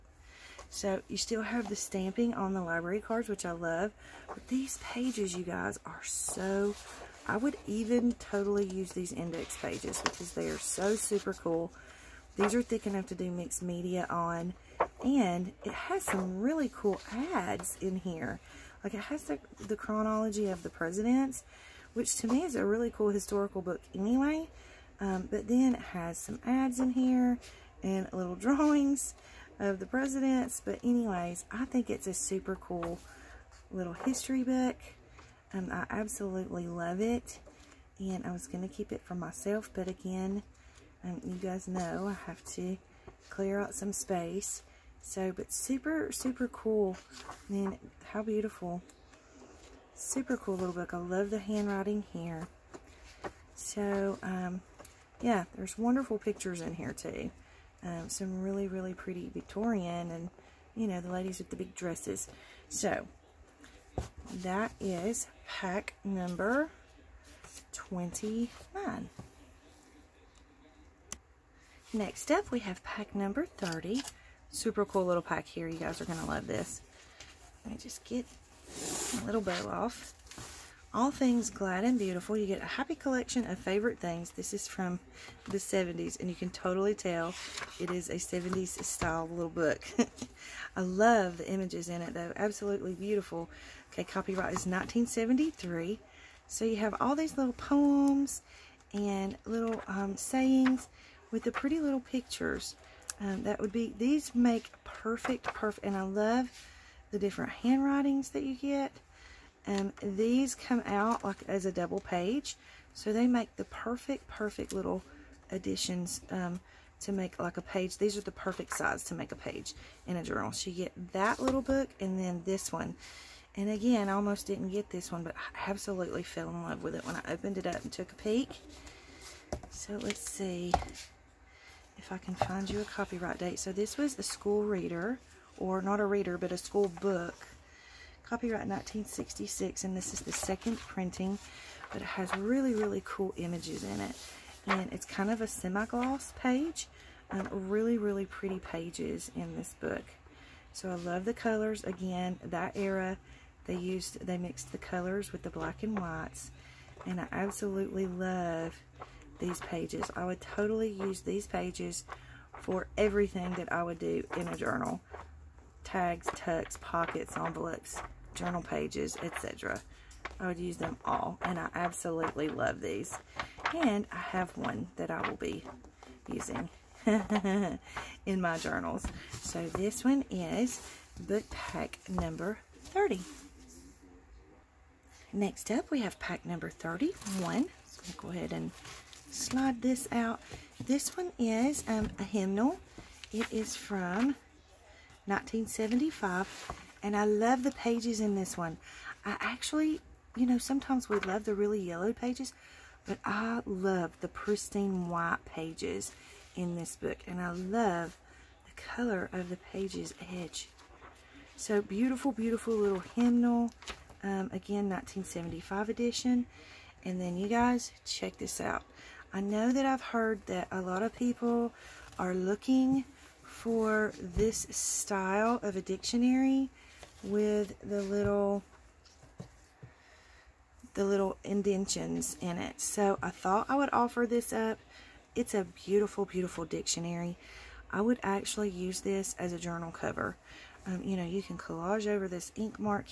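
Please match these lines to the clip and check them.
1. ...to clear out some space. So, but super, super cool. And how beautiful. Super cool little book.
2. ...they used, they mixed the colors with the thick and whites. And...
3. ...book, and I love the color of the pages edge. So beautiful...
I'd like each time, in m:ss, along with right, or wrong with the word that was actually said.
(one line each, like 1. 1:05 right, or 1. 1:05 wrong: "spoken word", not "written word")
1. 0:42 right
2. 2:33 wrong: "black", not "thick"
3. 3:26 right.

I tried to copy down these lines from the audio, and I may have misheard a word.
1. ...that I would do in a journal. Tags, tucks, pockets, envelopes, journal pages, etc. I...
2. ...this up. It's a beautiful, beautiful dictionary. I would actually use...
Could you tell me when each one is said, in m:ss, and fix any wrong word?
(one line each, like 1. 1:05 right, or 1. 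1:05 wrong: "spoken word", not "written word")
1. 2:43 right
2. 3:54 right.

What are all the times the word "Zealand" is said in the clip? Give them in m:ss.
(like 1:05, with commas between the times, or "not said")
not said.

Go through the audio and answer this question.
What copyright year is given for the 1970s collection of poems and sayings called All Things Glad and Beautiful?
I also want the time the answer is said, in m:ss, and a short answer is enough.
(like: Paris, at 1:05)
1973, at 1:34.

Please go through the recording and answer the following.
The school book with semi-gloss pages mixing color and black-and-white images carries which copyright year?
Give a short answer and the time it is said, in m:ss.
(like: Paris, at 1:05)
1966, at 2:18.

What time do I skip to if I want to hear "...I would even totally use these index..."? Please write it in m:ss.
0:07.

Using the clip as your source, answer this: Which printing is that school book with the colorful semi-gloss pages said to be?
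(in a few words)
second printing.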